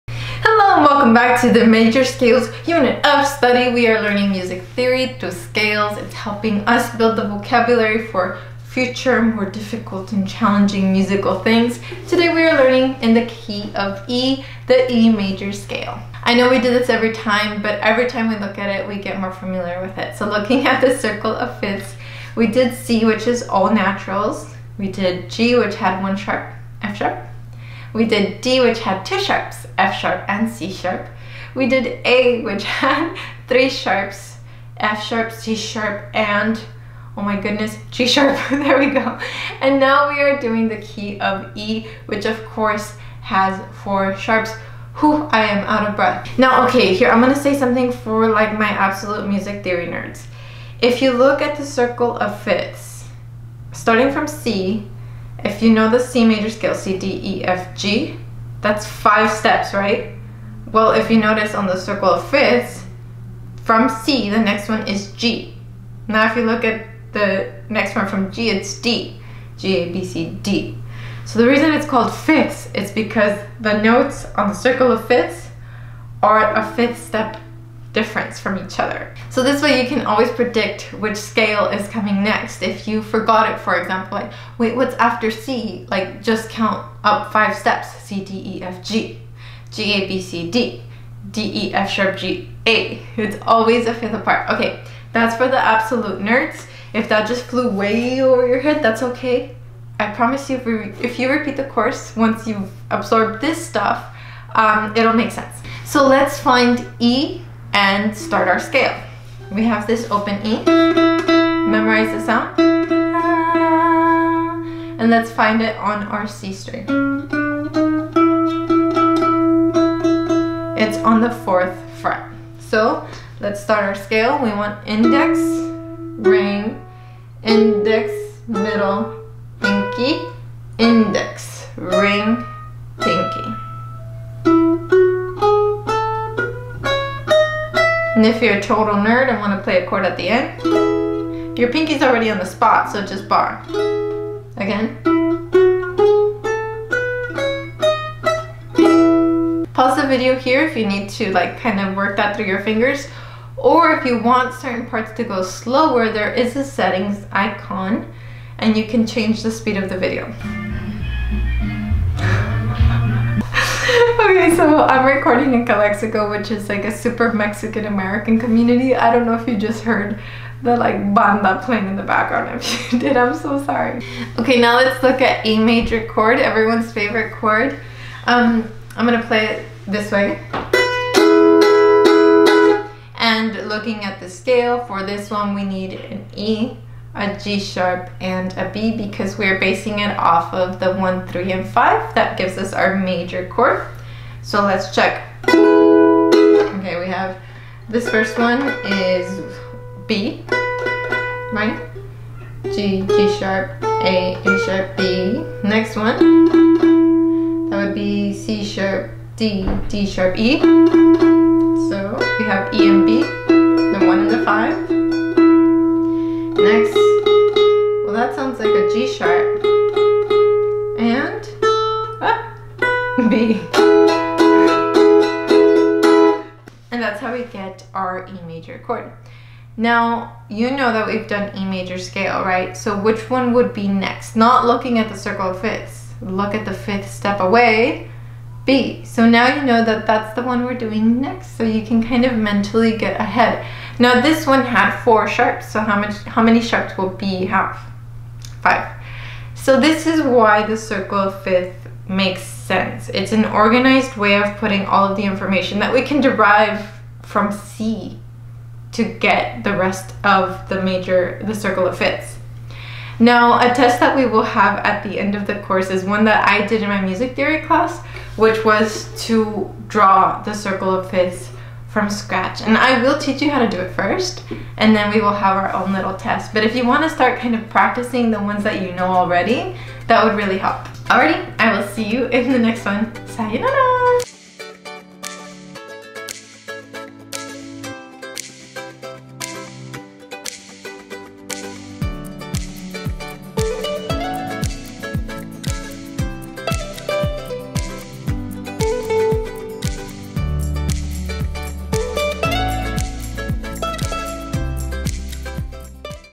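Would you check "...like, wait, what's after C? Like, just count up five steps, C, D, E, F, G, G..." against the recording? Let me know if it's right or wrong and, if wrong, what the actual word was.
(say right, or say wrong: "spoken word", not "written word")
right.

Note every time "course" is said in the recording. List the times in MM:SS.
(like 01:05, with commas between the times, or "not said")
00:42, 01:41, 04:25.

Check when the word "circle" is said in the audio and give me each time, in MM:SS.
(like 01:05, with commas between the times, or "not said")
00:20, 00:51, 01:01, 01:14, 03:55, 04:10, 04:21, 04:30.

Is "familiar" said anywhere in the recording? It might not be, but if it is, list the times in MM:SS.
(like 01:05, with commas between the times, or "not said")
00:19.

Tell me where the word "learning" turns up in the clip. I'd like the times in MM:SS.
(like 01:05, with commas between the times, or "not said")
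00:04, 00:12.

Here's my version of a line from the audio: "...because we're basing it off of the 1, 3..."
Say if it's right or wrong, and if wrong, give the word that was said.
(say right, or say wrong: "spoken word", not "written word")
right.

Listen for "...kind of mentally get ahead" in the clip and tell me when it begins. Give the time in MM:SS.
04:02.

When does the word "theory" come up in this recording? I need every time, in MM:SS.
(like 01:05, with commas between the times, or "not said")
00:04, 00:49, 04:27.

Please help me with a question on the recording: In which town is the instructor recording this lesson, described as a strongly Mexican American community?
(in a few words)
Calexico.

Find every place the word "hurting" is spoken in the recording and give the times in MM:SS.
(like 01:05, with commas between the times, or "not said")
not said.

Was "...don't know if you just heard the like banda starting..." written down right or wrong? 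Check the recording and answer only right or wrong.
wrong.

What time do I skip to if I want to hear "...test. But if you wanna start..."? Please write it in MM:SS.
04:36.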